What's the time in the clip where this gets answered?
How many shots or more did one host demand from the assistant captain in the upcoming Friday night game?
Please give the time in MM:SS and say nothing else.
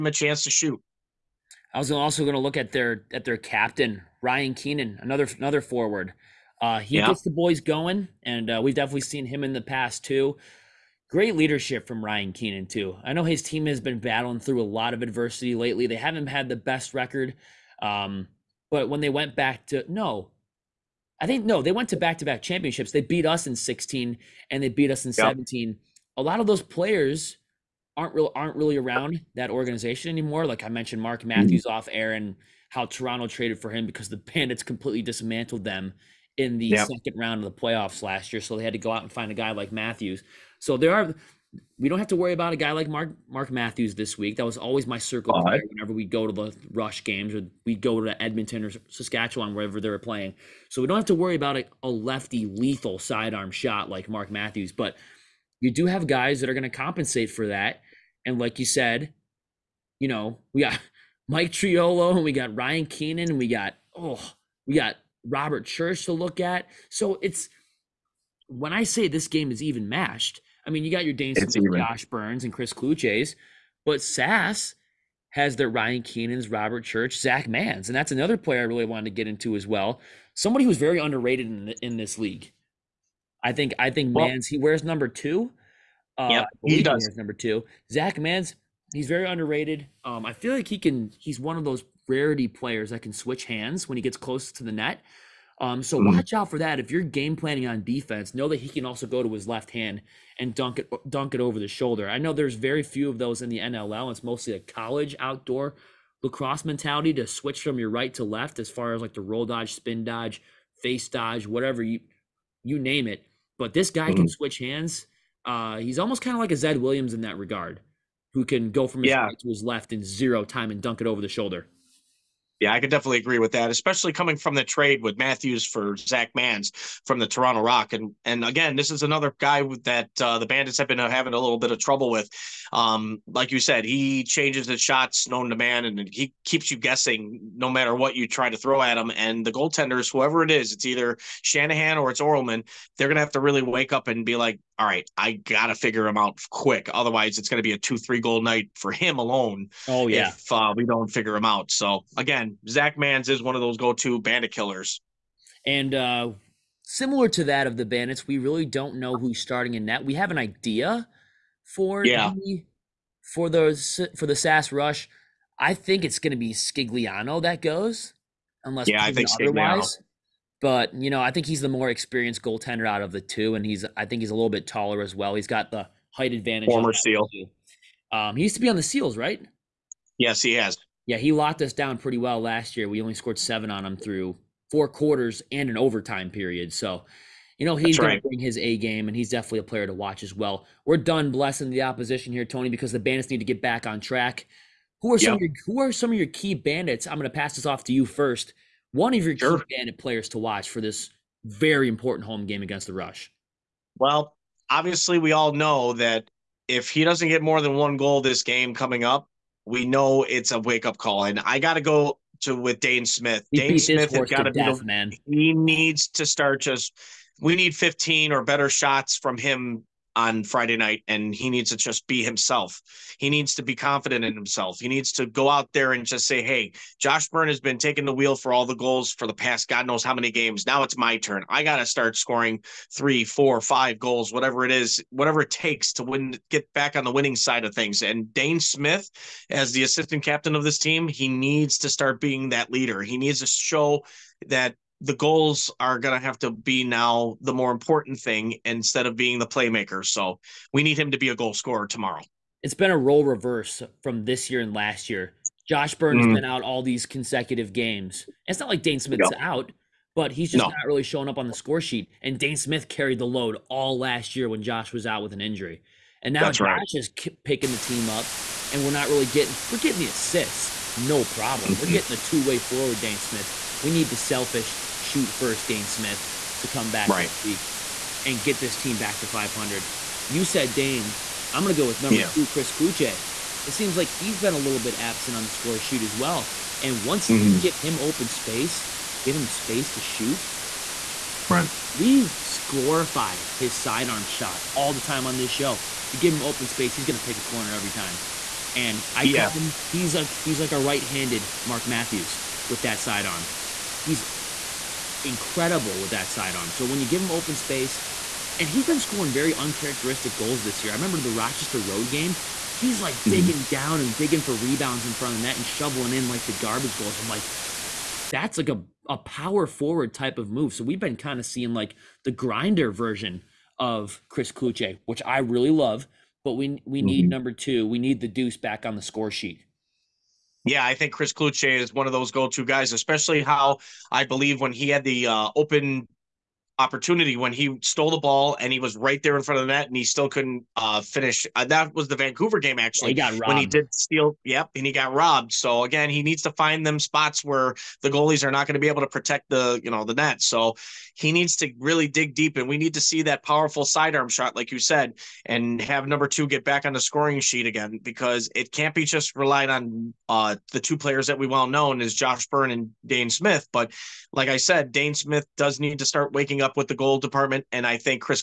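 03:37.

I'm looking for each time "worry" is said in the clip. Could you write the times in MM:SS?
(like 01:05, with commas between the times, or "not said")
00:42, 00:51.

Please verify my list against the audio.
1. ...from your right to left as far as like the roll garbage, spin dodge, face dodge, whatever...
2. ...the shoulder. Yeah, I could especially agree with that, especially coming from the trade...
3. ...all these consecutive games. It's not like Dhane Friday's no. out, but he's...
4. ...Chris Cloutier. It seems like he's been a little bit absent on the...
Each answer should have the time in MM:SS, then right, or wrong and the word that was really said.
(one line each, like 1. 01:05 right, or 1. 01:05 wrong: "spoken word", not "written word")
1. 01:47 wrong: "dodge", not "garbage"
2. 02:01 wrong: "definitely", not "especially"
3. 04:16 wrong: "Smith", not "Friday"
4. 04:42 right.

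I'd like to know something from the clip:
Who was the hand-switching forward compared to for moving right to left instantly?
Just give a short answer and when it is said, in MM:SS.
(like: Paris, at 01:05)
Zed Williams, at 01:56.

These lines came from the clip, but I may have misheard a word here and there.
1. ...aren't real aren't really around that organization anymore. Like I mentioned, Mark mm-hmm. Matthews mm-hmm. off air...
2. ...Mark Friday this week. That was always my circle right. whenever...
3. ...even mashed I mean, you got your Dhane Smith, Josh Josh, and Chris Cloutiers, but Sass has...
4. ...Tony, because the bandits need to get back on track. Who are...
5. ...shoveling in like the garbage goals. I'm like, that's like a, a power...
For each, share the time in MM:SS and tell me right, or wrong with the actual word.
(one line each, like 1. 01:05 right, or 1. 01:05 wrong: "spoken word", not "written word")
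1. 00:27 right
2. 00:43 wrong: "Matthews", not "Friday"
3. 01:09 wrong: "Byrnes", not "Josh"
4. 03:12 right
5. 05:15 right.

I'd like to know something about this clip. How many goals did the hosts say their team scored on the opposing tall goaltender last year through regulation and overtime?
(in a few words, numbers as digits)
7.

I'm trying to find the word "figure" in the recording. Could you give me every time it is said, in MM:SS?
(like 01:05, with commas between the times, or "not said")
02:25, 02:31.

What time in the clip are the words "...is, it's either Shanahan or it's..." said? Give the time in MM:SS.
02:20.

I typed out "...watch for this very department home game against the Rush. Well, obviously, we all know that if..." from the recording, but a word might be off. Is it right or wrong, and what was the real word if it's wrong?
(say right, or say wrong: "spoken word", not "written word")
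wrong: "important", not "department".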